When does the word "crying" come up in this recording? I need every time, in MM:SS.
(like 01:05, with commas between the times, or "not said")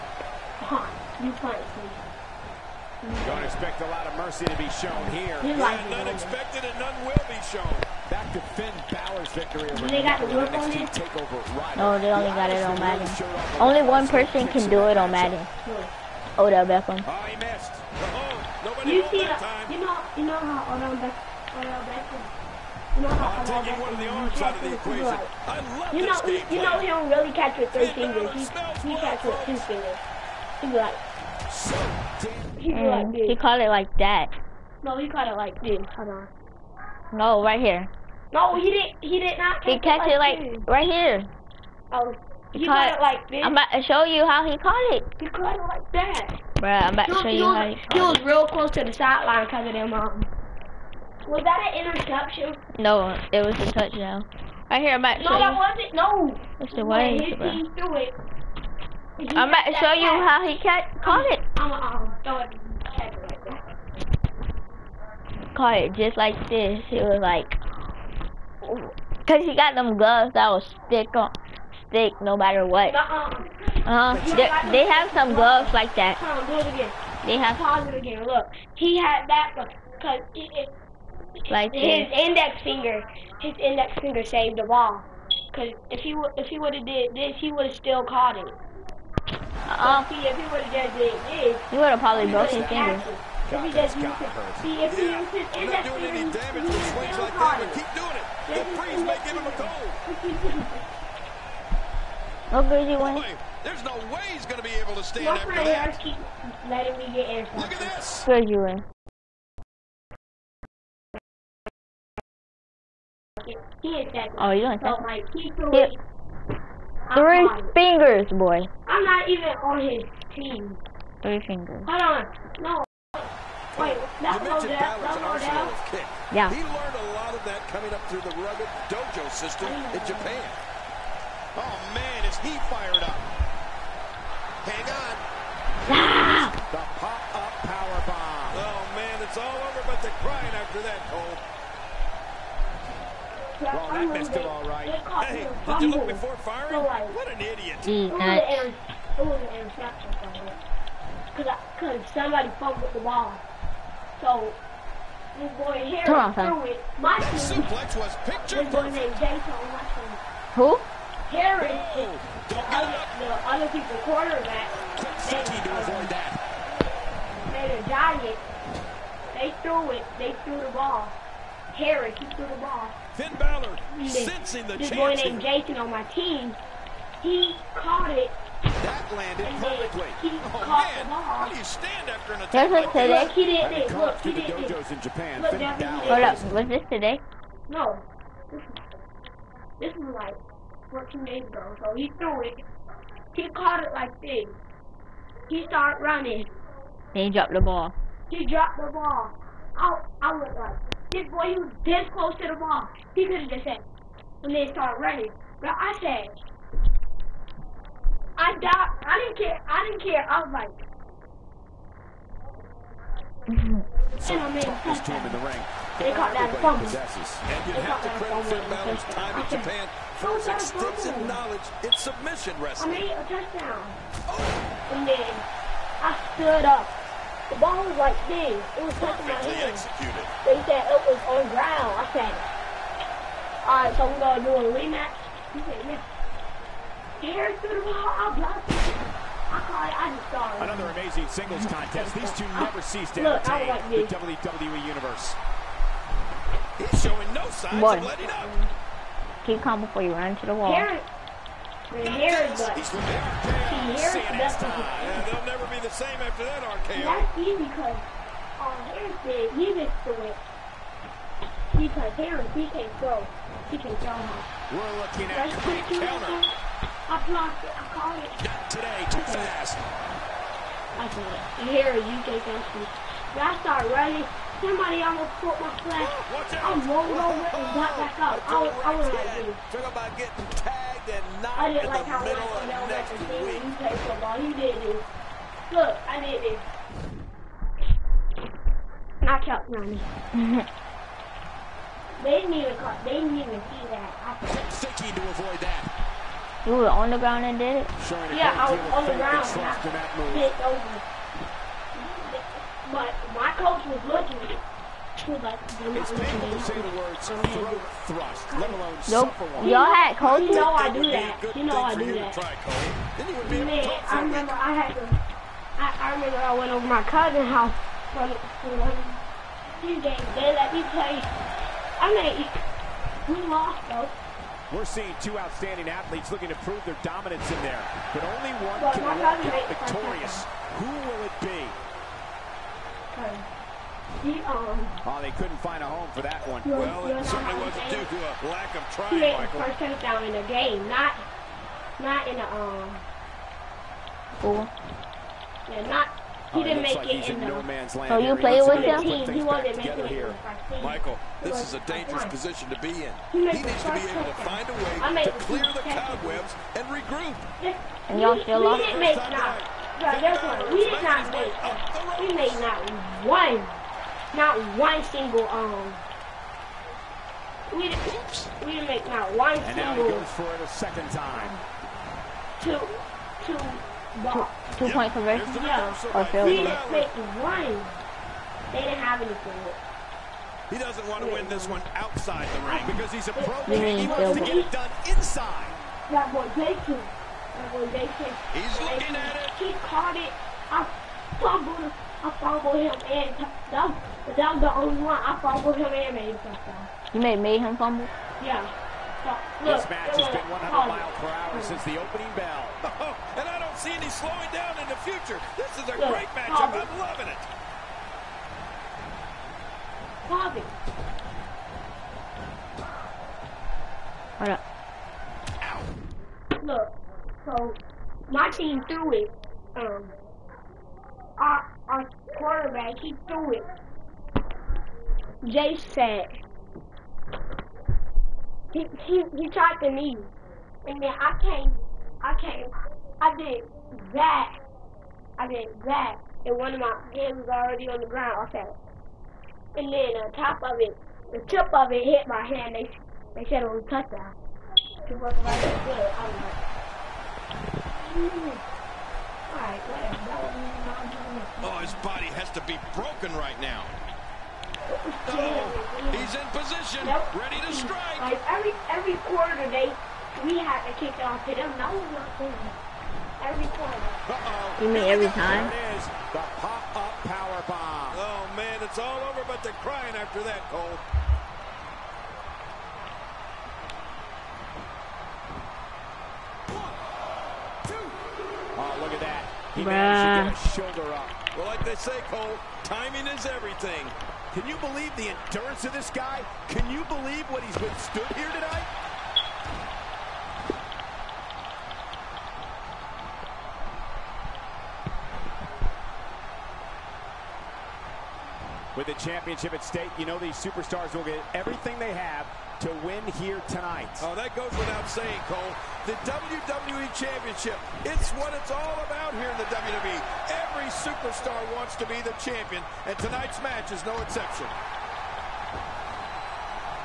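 02:20, 07:49.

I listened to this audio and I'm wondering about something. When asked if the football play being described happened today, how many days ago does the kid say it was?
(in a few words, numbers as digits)
14.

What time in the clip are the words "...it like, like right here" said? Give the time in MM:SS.
00:40.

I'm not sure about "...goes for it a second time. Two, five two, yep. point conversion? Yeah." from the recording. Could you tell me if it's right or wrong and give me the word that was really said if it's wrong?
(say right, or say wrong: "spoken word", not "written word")
wrong: "two", not "five".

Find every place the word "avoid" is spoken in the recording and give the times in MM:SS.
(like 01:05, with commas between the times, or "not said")
02:45, 04:55.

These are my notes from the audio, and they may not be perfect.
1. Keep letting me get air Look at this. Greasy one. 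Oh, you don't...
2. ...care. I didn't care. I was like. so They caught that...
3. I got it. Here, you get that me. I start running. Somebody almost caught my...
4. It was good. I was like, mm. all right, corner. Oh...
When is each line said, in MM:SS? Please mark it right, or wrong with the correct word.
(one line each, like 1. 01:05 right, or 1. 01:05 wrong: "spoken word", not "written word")
1. 01:46 right
2. 03:29 right
3. 04:29 right
4. 07:25 wrong: "whatever", not "corner".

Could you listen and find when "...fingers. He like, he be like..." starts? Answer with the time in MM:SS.
00:29.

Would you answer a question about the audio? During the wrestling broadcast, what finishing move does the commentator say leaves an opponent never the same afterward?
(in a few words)
RKO.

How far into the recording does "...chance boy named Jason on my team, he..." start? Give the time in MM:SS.
02:54.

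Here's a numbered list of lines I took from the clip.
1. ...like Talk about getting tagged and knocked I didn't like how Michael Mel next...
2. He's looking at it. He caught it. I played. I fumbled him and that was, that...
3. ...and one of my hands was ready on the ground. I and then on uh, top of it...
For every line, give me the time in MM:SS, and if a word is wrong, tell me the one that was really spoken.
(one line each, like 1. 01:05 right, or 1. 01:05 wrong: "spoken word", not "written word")
1. 04:39 right
2. 06:28 wrong: "fumbled", not "played"
3. 07:16 wrong: "already", not "ready".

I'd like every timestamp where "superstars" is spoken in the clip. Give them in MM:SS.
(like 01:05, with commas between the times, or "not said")
08:20, 08:30.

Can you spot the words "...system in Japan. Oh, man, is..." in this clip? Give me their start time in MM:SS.
02:09.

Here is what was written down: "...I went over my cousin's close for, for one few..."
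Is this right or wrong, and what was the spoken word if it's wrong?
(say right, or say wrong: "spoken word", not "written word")
wrong: "house", not "close".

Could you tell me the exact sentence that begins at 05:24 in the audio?
We're seeing two outstanding athletes looking to prove their dominance in there.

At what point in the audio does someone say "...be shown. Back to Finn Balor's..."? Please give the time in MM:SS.
00:07.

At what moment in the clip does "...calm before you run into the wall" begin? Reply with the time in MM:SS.
04:09.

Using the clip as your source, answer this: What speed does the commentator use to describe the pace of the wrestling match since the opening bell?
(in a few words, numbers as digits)
100 miles per hour.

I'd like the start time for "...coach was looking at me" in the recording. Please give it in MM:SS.
05:03.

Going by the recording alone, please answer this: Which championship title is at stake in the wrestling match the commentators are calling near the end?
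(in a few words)
WWE Championship.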